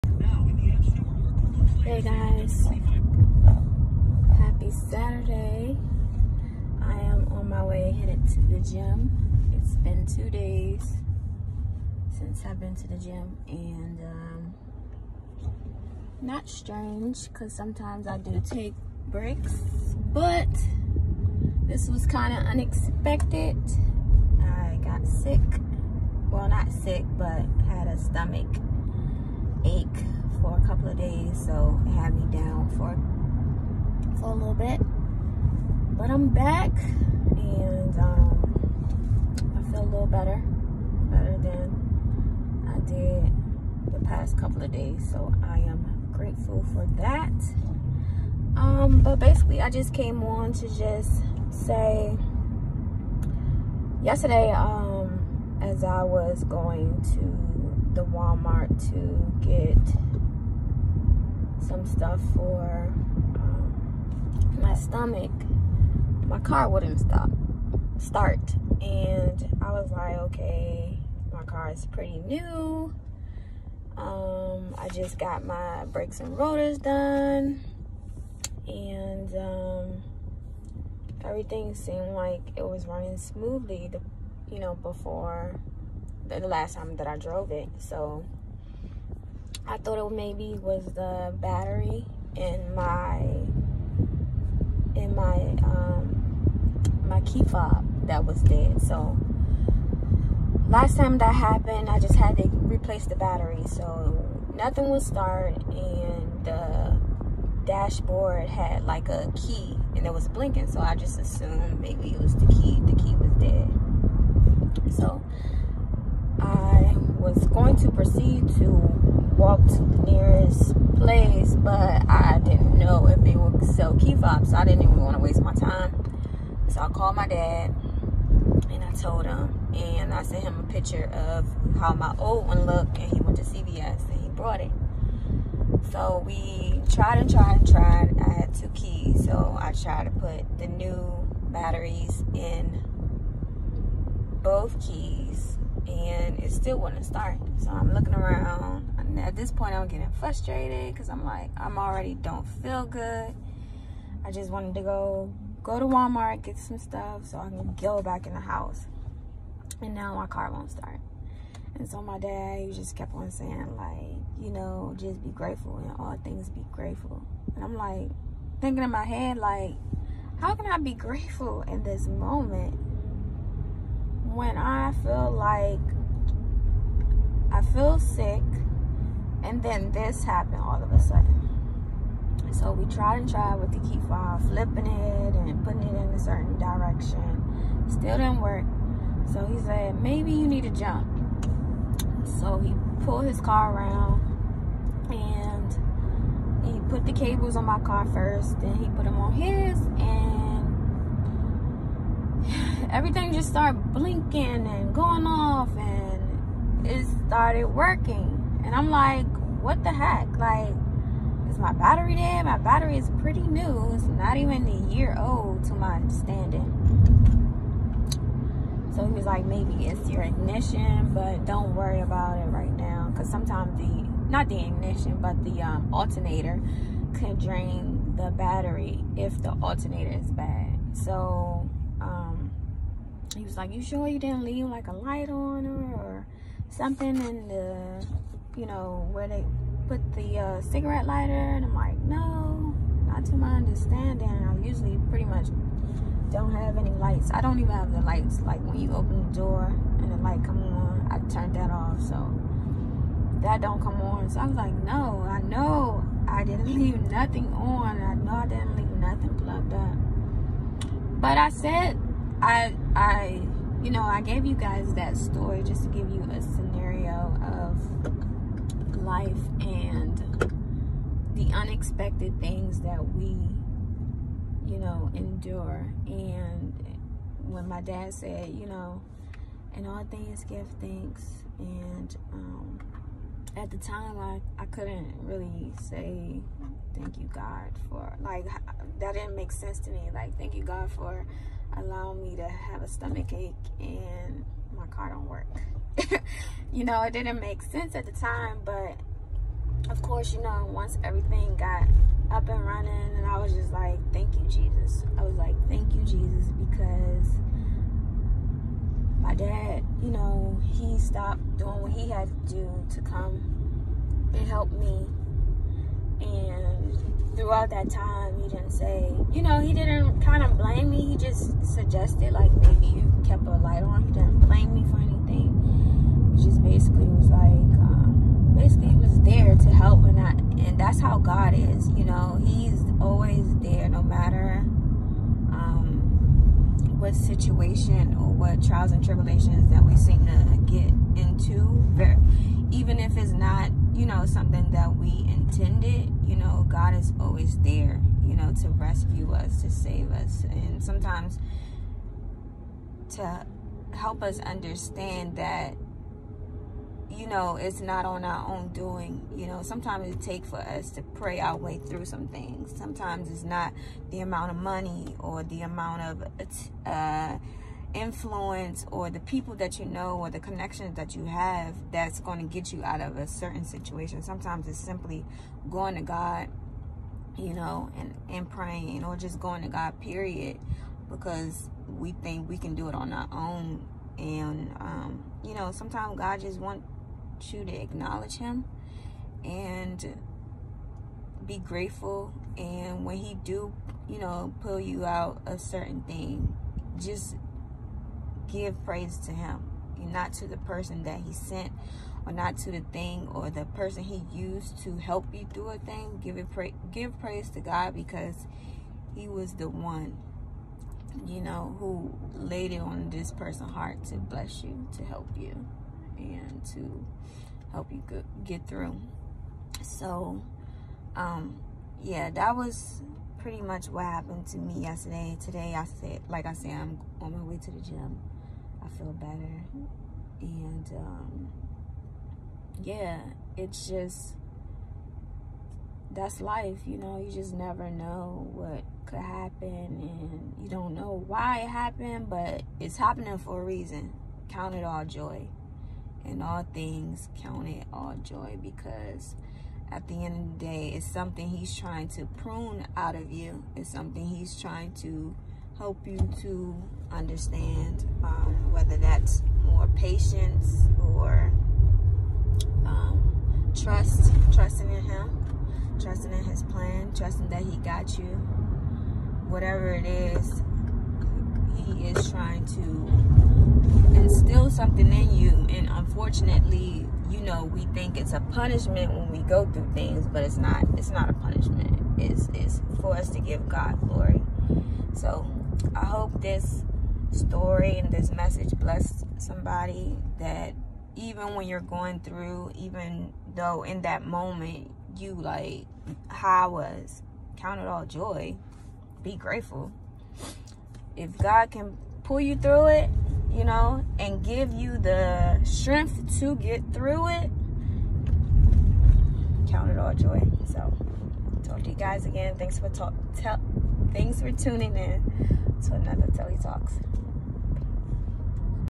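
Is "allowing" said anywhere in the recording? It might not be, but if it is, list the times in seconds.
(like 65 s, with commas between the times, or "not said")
291 s.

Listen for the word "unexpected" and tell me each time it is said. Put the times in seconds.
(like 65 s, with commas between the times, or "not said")
22 s, 271 s.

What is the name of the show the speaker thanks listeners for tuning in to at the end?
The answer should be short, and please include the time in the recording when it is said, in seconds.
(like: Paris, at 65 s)
Telly Talks, at 516 s.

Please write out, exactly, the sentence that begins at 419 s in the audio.
So, um, yeah, that was pretty much what happened to me yesterday.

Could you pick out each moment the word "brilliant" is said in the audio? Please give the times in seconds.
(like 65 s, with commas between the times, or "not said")
not said.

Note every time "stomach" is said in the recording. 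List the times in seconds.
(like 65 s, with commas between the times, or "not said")
27 s, 64 s, 292 s.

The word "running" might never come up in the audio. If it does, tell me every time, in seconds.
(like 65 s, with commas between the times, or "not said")
82 s, 302 s.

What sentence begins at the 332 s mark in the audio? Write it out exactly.
He's always there no matter um, what situation or what trials and tribulations that we seem to get into.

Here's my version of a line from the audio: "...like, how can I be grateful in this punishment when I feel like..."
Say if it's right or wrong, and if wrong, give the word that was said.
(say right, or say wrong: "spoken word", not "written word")
wrong: "moment", not "punishment".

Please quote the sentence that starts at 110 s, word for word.
So I just assumed maybe it was the key.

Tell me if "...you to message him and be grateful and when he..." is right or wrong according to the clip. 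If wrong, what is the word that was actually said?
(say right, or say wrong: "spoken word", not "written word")
wrong: "acknowledge", not "message".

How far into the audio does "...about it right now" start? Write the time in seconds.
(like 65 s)
222 s.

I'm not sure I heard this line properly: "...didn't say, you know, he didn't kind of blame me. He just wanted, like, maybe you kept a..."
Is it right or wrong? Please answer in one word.
wrong.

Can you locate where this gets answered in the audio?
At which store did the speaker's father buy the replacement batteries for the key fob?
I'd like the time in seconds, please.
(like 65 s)
133 s.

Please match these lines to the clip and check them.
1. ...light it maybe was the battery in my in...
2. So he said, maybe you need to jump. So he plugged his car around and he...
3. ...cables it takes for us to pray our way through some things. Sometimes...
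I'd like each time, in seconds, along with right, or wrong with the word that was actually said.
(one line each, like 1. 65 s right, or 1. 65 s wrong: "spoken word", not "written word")
1. 89 s wrong: "thought", not "light"
2. 189 s wrong: "pulled", not "plugged"
3. 359 s wrong: "sometimes", not "cables".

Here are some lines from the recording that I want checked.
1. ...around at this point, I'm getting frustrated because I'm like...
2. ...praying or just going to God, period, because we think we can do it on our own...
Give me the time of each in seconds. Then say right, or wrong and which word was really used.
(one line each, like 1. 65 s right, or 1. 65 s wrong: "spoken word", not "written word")
1. 148 s right
2. 378 s right.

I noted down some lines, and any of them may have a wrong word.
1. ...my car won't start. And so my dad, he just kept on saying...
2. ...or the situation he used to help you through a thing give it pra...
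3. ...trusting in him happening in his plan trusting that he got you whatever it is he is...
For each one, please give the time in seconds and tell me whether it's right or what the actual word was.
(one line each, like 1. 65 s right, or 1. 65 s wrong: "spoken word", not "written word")
1. 160 s right
2. 403 s wrong: "person", not "situation"
3. 464 s wrong: "trusting", not "happening".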